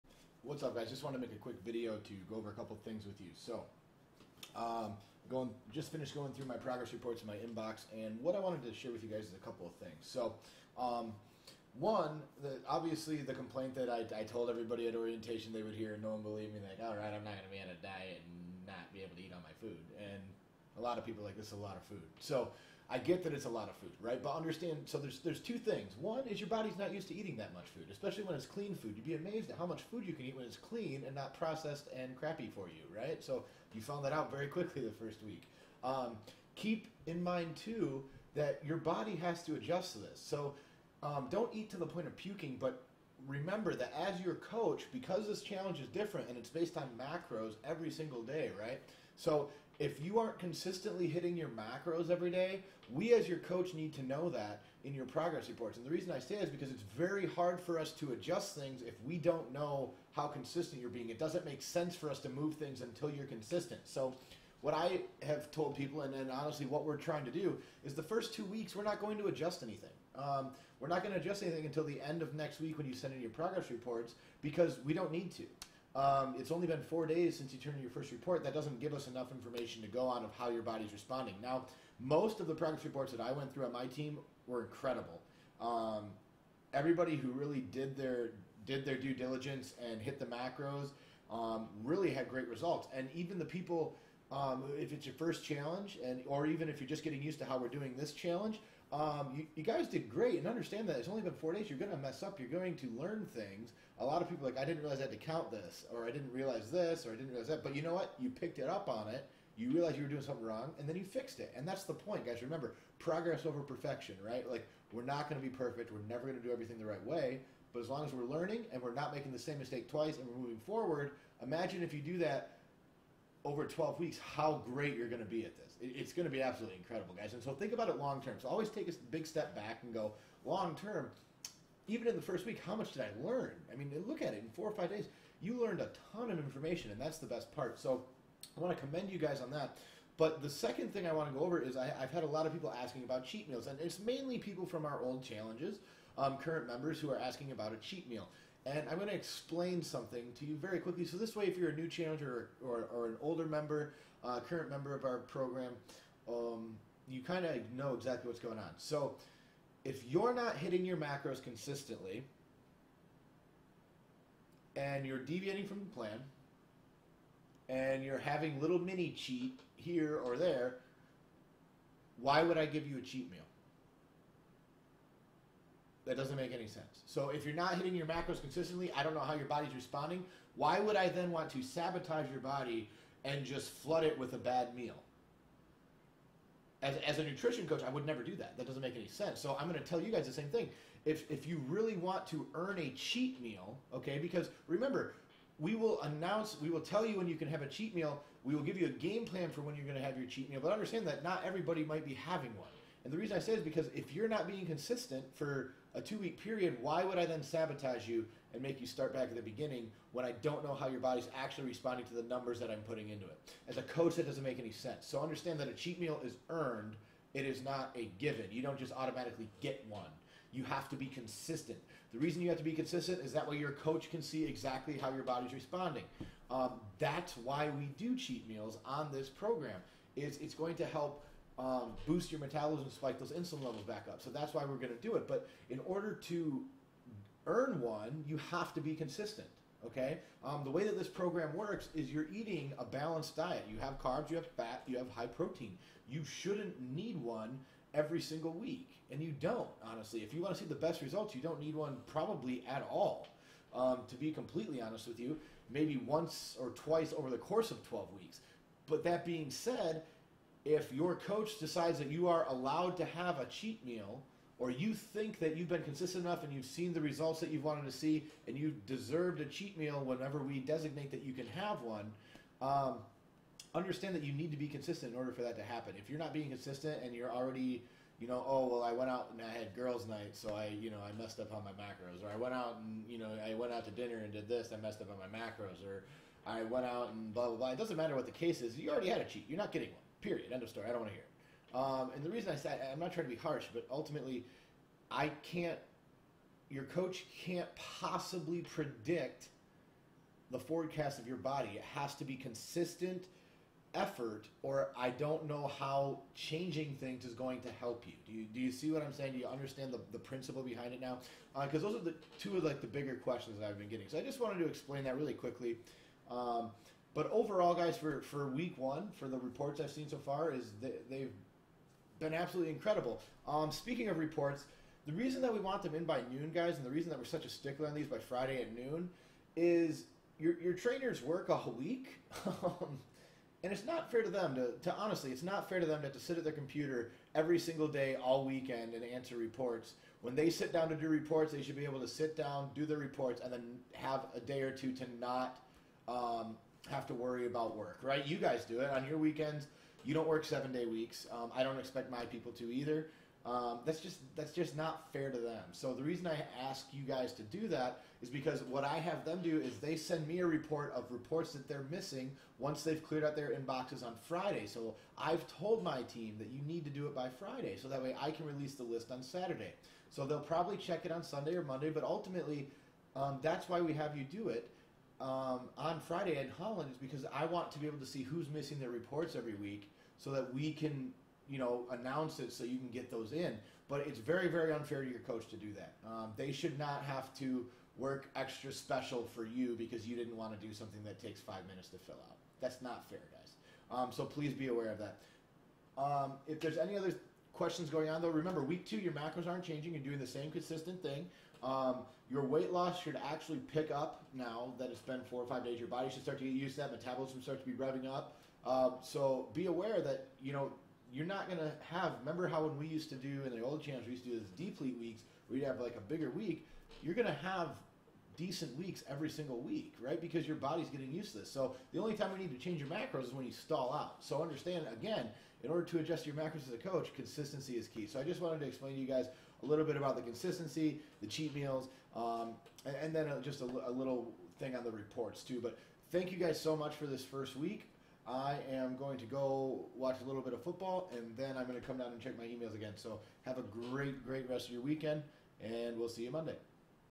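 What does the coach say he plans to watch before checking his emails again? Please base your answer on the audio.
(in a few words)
Football.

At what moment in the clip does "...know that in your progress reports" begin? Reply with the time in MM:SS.
00:54.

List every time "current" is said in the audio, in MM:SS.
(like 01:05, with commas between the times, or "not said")
02:26, 02:34.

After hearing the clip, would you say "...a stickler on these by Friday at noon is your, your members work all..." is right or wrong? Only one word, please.
wrong.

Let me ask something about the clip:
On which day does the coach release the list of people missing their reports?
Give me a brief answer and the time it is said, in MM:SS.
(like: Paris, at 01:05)
Saturday, at 06:09.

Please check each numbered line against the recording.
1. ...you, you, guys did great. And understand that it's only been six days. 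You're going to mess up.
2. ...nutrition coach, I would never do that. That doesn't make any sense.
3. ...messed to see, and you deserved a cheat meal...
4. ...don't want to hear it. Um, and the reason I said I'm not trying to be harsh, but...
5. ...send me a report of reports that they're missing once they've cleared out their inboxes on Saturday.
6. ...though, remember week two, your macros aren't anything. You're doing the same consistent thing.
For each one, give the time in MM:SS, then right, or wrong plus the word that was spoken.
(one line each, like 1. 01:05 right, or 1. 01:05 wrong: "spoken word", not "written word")
1. 01:39 wrong: "four", not "six"
2. 03:07 right
3. 04:27 wrong: "wanted", not "messed"
4. 04:50 right
5. 05:59 wrong: "Friday", not "Saturday"
6. 06:38 wrong: "changing", not "anything".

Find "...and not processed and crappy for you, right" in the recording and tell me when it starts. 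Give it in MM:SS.
00:31.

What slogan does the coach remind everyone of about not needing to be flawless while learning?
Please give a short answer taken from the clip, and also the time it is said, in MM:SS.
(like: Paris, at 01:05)
Progress over perfection, at 01:52.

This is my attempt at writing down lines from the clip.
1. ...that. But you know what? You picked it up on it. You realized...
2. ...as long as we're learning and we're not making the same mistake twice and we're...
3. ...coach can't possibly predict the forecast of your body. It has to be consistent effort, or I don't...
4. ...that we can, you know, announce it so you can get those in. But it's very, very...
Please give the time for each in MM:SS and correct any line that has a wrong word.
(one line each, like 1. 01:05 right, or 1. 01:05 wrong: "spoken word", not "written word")
1. 01:47 right
2. 01:57 right
3. 04:56 right
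4. 06:20 right.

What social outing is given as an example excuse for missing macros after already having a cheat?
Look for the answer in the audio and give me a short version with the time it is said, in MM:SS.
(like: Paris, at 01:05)
Girls' night, at 04:39.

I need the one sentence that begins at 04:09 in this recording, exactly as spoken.
Honestly, if you want to see the best results, you don't need one probably at all.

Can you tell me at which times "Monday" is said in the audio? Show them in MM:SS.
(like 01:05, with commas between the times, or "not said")
06:11, 07:26.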